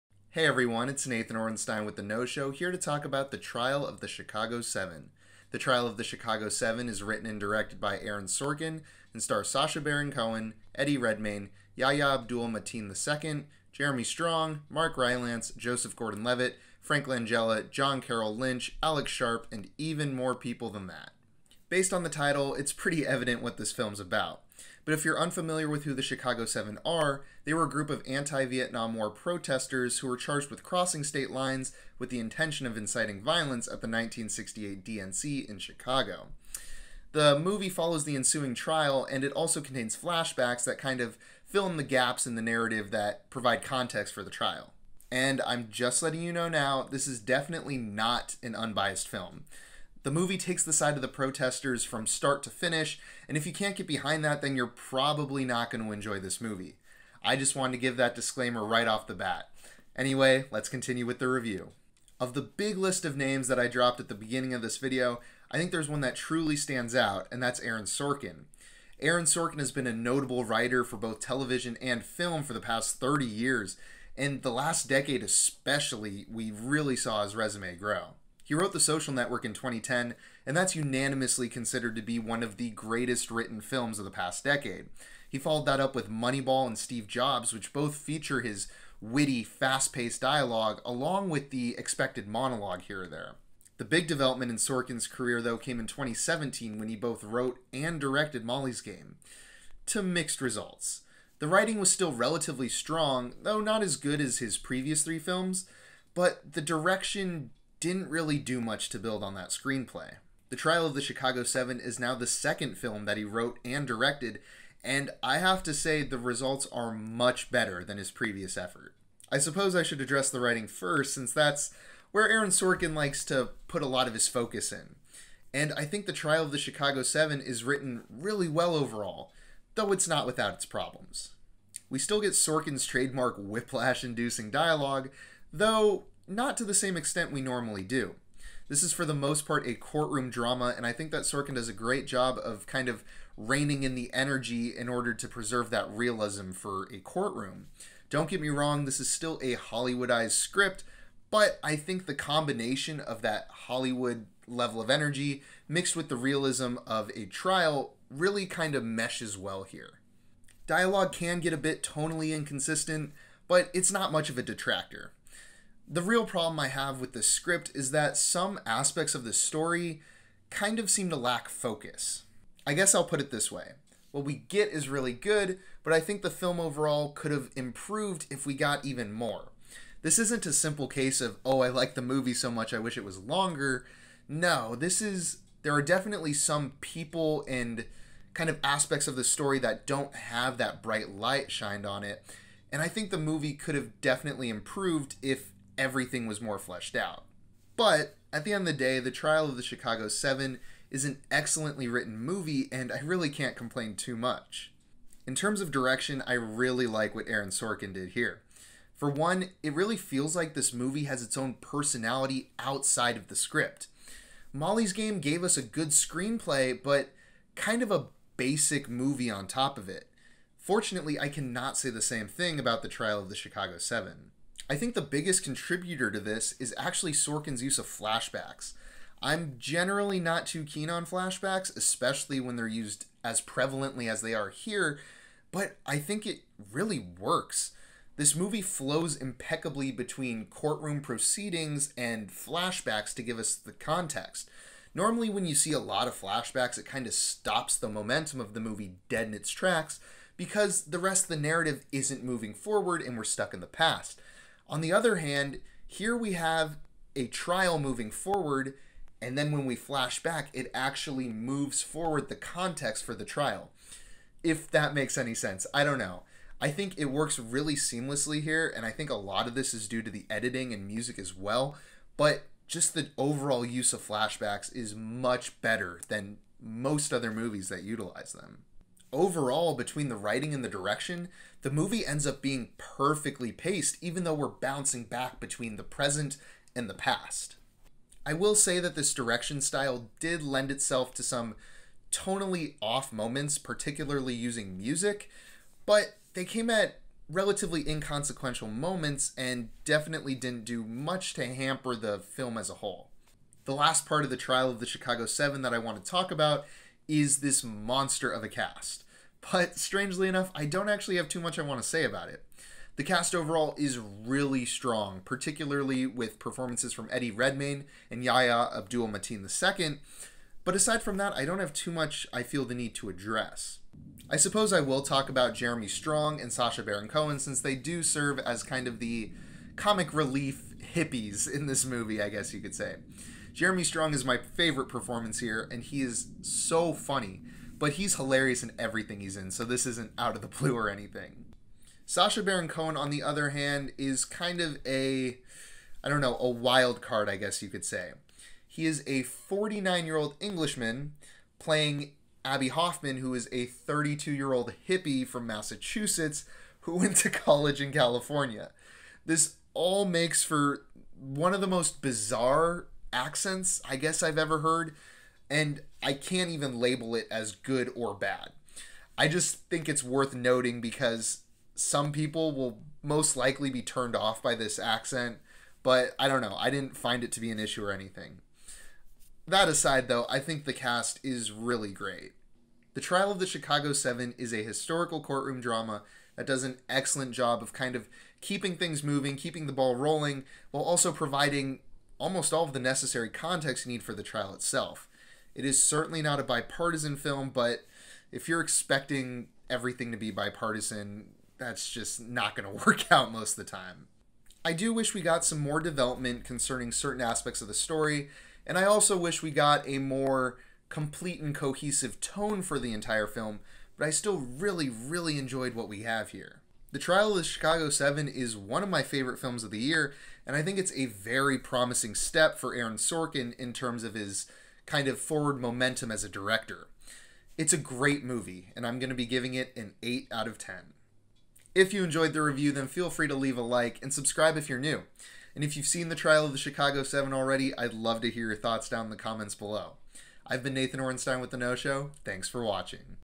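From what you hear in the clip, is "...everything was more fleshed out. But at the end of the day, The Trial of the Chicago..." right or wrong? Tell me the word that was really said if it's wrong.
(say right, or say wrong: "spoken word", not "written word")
right.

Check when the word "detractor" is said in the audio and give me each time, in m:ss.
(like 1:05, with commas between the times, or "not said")
2:44.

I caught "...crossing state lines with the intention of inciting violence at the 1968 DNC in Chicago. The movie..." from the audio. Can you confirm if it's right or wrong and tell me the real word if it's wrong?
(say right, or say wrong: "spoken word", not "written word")
right.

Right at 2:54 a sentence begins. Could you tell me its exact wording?
What we get is really good, but I think the film overall could have improved if we got even more.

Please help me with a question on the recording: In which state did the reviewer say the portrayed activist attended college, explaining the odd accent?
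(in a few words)
California.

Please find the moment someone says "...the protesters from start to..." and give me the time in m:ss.
0:51.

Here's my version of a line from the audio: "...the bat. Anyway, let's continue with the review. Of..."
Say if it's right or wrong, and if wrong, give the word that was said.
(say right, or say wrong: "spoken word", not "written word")
right.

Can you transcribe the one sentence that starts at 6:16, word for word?
I didn't find it to be an issue or anything.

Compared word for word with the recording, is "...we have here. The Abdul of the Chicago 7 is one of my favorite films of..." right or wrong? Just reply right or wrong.
wrong.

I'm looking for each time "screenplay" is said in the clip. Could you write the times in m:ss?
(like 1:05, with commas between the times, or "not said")
1:49, 3:35.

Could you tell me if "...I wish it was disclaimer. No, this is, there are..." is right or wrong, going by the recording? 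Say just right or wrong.
wrong.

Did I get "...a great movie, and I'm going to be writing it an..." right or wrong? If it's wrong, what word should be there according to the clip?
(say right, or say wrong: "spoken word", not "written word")
wrong: "giving", not "writing".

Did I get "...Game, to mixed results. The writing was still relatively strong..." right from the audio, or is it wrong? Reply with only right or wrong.
right.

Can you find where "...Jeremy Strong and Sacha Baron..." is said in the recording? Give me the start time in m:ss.
5:25.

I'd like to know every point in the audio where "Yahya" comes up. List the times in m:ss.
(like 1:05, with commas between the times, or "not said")
0:11, 5:18.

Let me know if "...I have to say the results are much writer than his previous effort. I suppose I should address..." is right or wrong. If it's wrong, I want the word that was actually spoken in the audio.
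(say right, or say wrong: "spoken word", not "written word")
wrong: "better", not "writer".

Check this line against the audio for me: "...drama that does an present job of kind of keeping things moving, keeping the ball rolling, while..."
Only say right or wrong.
wrong.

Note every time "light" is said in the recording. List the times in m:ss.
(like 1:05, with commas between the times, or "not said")
3:11.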